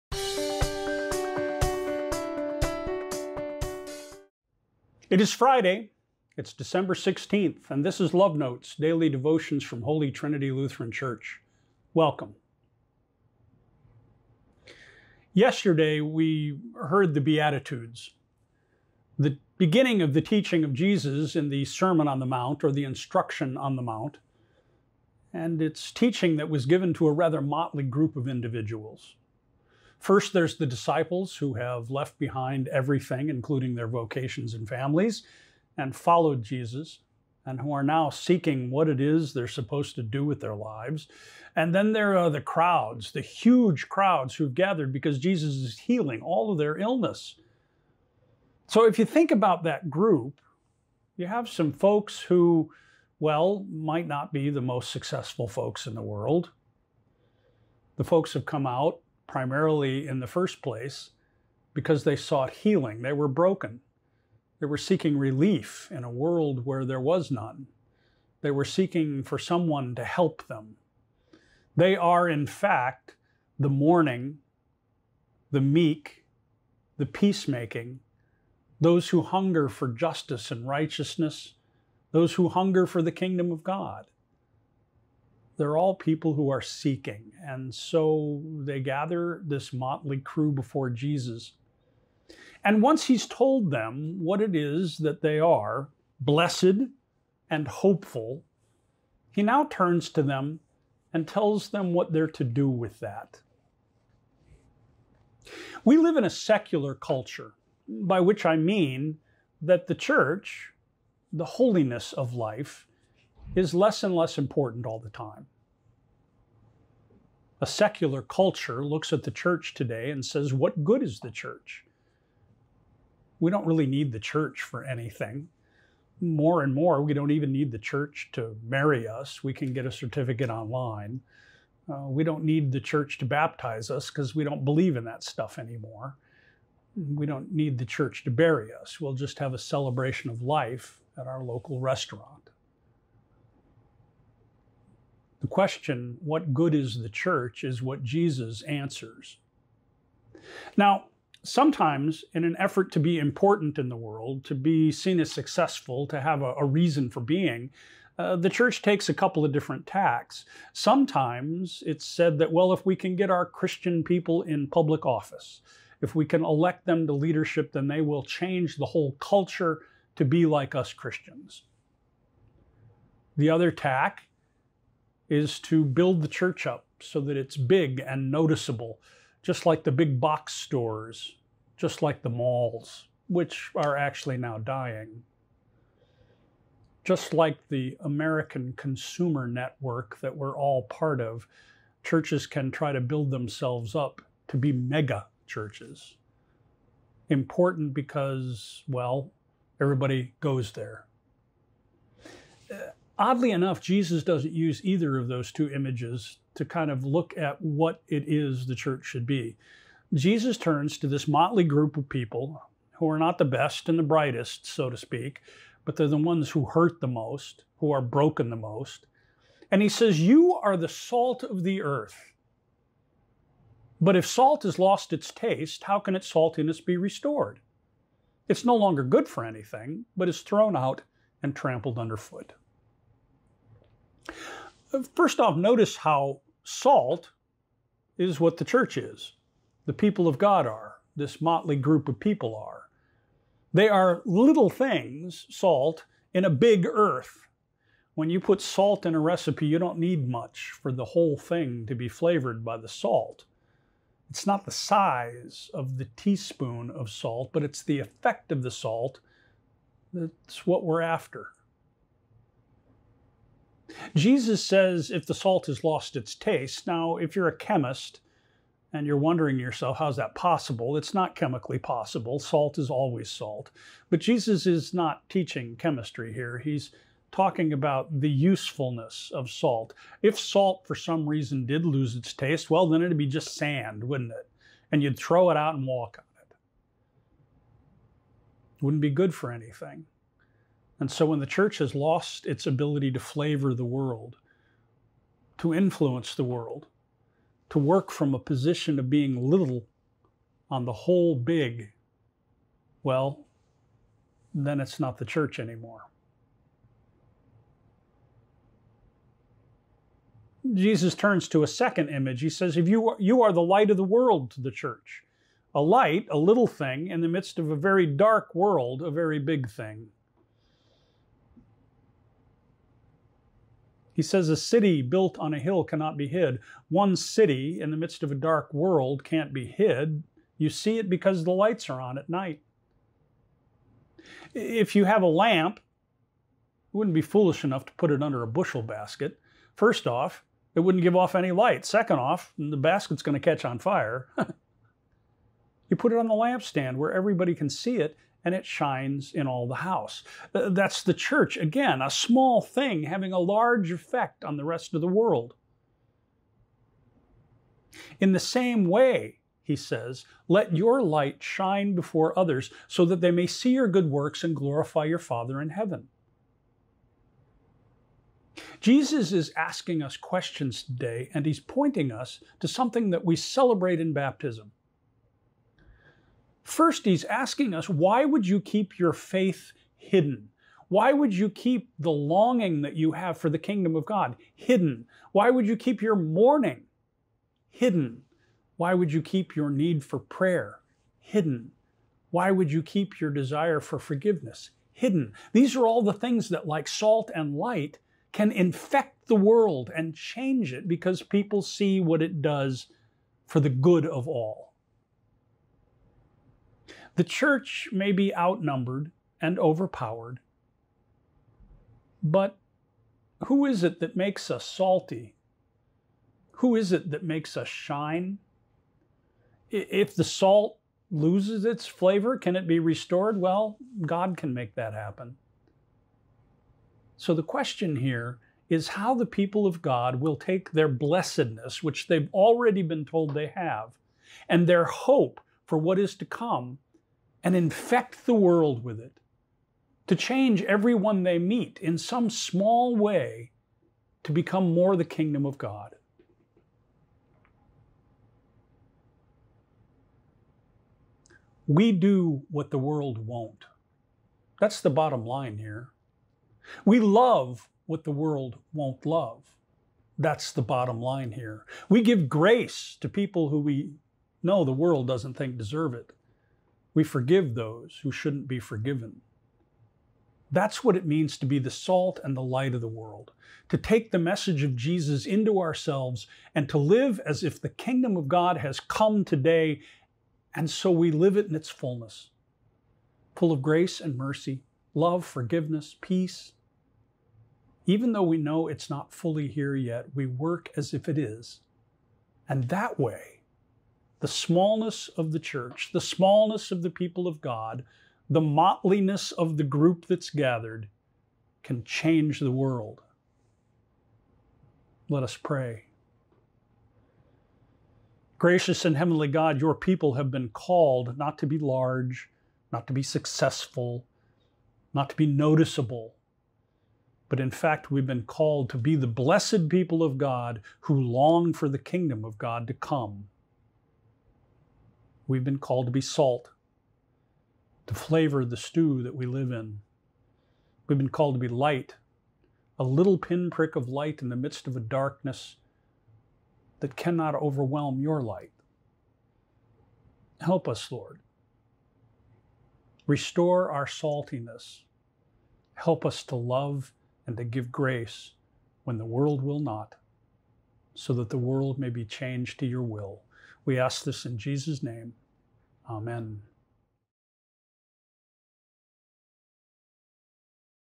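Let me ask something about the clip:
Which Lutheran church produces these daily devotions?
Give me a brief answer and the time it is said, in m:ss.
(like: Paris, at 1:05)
Holy Trinity Lutheran Church, at 0:09.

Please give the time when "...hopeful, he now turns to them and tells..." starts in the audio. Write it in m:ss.
1:37.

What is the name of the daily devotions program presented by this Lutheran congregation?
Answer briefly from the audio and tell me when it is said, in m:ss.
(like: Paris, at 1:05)
Love Notes, at 0:08.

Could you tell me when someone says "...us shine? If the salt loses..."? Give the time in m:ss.
6:57.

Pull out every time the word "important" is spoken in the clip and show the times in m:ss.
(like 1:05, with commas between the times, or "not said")
1:54, 2:33, 3:17.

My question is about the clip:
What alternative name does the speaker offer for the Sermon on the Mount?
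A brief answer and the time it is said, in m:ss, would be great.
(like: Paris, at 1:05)
Instruction on the Mount, at 0:22.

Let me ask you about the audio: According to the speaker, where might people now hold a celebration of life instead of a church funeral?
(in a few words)
local restaurant.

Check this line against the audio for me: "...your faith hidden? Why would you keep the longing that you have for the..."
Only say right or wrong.
right.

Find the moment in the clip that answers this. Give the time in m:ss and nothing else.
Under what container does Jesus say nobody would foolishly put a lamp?
5:38.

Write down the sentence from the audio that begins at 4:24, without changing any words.
Jesus says if the salt has lost its taste.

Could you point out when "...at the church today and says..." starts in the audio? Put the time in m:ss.
1:59.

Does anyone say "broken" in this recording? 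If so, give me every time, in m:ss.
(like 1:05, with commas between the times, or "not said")
1:03, 3:38.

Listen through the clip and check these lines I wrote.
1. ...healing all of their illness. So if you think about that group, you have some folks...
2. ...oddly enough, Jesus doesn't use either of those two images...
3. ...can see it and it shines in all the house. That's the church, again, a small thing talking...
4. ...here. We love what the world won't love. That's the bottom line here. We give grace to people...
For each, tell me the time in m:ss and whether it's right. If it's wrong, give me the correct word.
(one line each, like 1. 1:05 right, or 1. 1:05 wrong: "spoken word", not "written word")
1. 0:45 right
2. 3:23 right
3. 5:47 wrong: "having", not "talking"
4. 7:35 right.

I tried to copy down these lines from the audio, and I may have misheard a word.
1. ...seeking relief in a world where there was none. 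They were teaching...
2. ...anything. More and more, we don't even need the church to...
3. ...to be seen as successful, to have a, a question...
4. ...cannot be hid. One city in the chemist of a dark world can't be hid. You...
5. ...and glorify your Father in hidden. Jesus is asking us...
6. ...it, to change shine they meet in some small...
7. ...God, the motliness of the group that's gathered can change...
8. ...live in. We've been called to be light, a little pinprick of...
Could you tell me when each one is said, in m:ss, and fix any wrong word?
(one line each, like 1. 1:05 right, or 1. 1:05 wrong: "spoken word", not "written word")
1. 1:04 wrong: "seeking", not "teaching"
2. 2:04 right
3. 2:34 wrong: "reason", not "question"
4. 5:25 wrong: "midst", not "chemist"
5. 6:04 wrong: "heaven", not "hidden"
6. 7:18 wrong: "everyone", not "shine"
7. 8:17 right
8. 8:49 right.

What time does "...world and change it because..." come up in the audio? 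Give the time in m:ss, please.
6:39.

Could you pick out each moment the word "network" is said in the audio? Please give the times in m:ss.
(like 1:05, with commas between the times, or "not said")
3:09.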